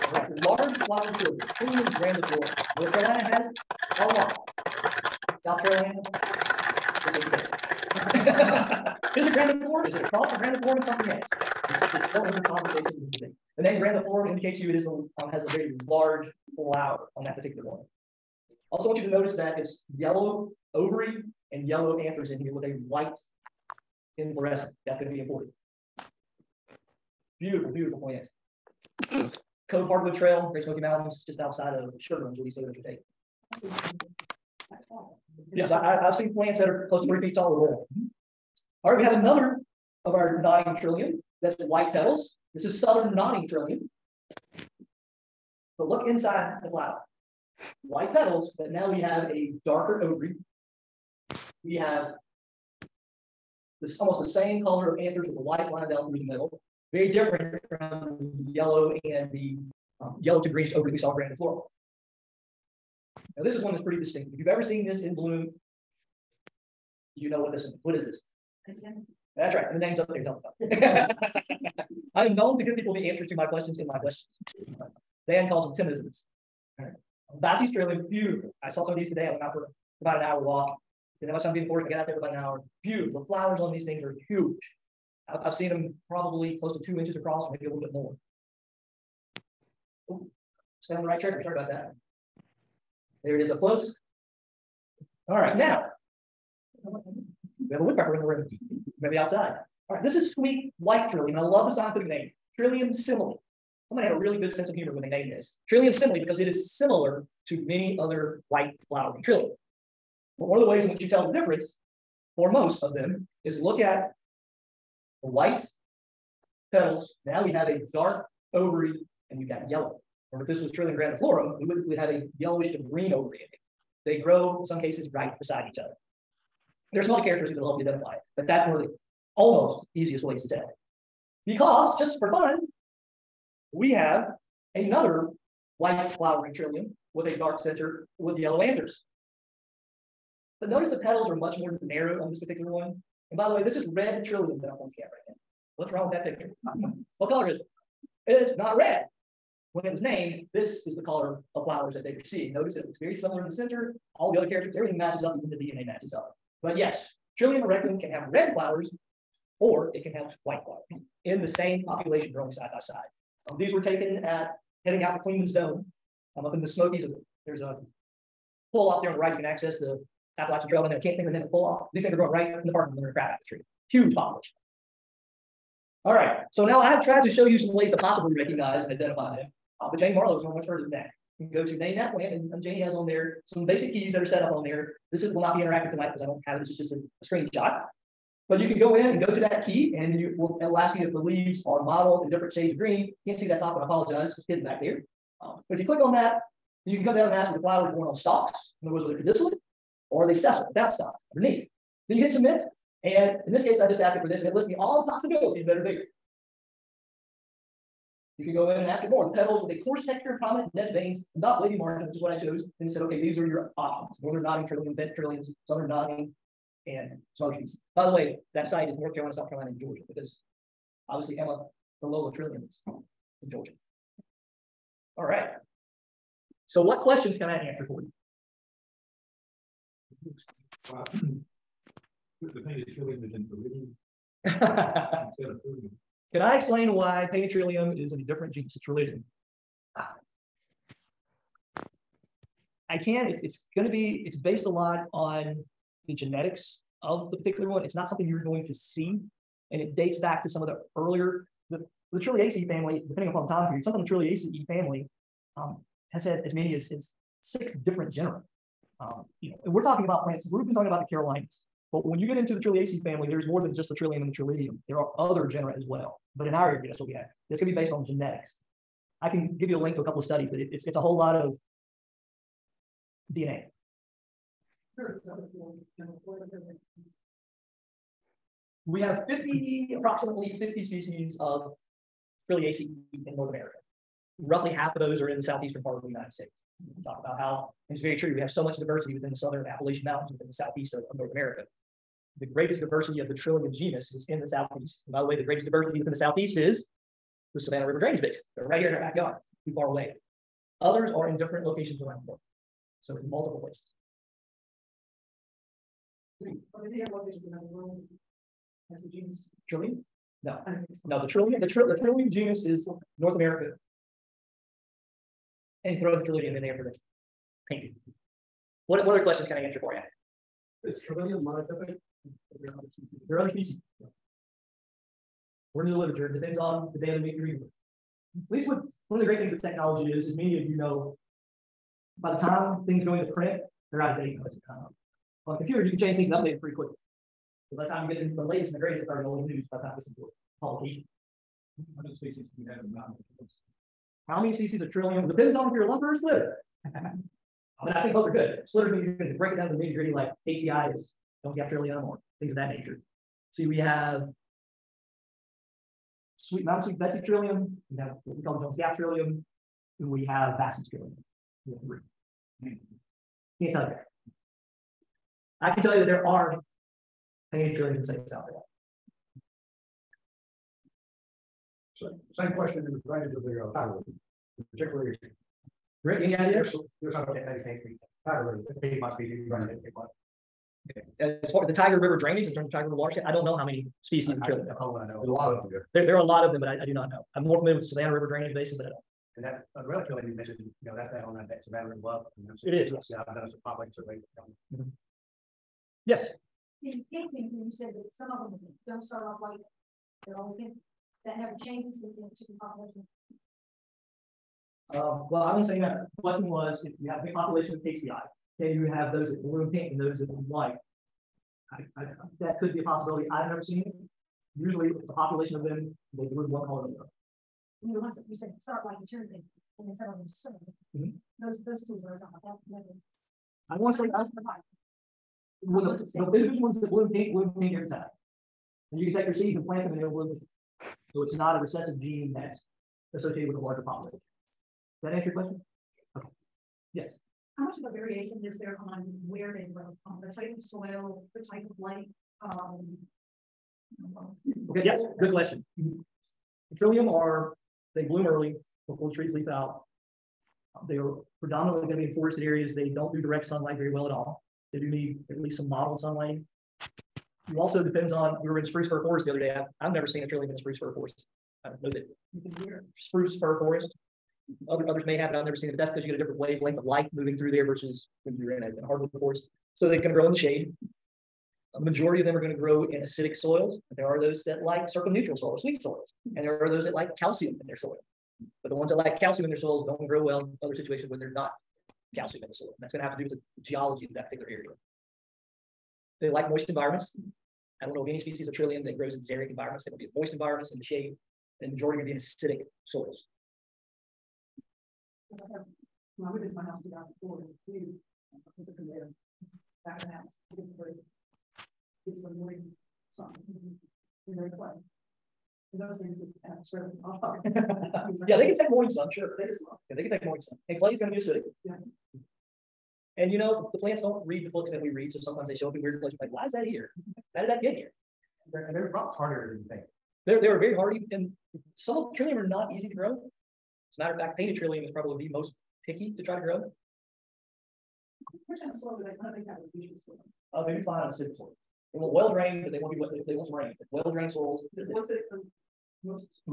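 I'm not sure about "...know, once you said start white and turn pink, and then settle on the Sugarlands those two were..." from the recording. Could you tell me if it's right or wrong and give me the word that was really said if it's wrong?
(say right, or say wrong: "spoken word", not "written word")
wrong: "Those", not "Sugarlands".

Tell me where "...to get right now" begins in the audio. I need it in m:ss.
2:24.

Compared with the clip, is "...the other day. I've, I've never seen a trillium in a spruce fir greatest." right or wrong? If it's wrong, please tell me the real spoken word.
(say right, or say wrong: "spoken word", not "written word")
wrong: "forest", not "greatest".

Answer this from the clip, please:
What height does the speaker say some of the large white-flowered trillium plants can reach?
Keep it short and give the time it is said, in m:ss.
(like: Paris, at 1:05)
three feet, at 0:37.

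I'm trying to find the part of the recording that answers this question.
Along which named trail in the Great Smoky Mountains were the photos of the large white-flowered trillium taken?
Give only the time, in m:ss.
0:29.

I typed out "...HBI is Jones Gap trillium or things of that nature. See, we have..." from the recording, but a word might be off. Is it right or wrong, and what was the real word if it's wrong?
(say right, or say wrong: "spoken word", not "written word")
right.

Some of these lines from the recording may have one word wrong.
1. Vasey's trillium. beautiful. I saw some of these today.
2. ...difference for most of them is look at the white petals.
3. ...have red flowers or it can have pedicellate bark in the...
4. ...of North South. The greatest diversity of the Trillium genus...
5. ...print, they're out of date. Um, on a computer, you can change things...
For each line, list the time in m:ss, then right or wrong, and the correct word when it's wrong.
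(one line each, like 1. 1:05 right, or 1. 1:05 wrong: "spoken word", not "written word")
1. 1:17 right
2. 1:51 right
3. 2:38 wrong: "white", not "pedicellate"
4. 4:51 wrong: "America", not "South"
5. 5:33 right.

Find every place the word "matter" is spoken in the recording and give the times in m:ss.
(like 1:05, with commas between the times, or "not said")
6:31, 8:44.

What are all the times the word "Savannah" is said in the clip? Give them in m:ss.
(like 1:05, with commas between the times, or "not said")
4:57, 6:27.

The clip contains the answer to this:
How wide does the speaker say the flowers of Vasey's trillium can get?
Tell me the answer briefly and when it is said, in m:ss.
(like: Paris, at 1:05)
2 inches, at 1:26.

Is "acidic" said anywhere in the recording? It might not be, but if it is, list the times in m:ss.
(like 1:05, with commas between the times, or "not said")
7:53, 8:12, 8:31, 8:55.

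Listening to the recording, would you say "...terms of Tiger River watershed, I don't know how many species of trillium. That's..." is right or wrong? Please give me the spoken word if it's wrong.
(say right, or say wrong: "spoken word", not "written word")
right.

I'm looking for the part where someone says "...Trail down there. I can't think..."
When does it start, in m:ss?
2:50.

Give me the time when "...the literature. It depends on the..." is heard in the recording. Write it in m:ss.
5:25.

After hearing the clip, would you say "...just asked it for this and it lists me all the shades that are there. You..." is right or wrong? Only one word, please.
wrong.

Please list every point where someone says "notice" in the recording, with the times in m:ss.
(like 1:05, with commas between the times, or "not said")
0:19, 2:20, 2:32.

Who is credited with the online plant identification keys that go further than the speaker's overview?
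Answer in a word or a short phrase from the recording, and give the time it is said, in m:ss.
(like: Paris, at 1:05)
Janie Marlowe, at 2:59.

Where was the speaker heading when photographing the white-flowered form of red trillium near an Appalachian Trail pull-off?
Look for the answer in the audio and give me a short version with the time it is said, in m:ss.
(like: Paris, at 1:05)
Clingman's Dome, at 2:45.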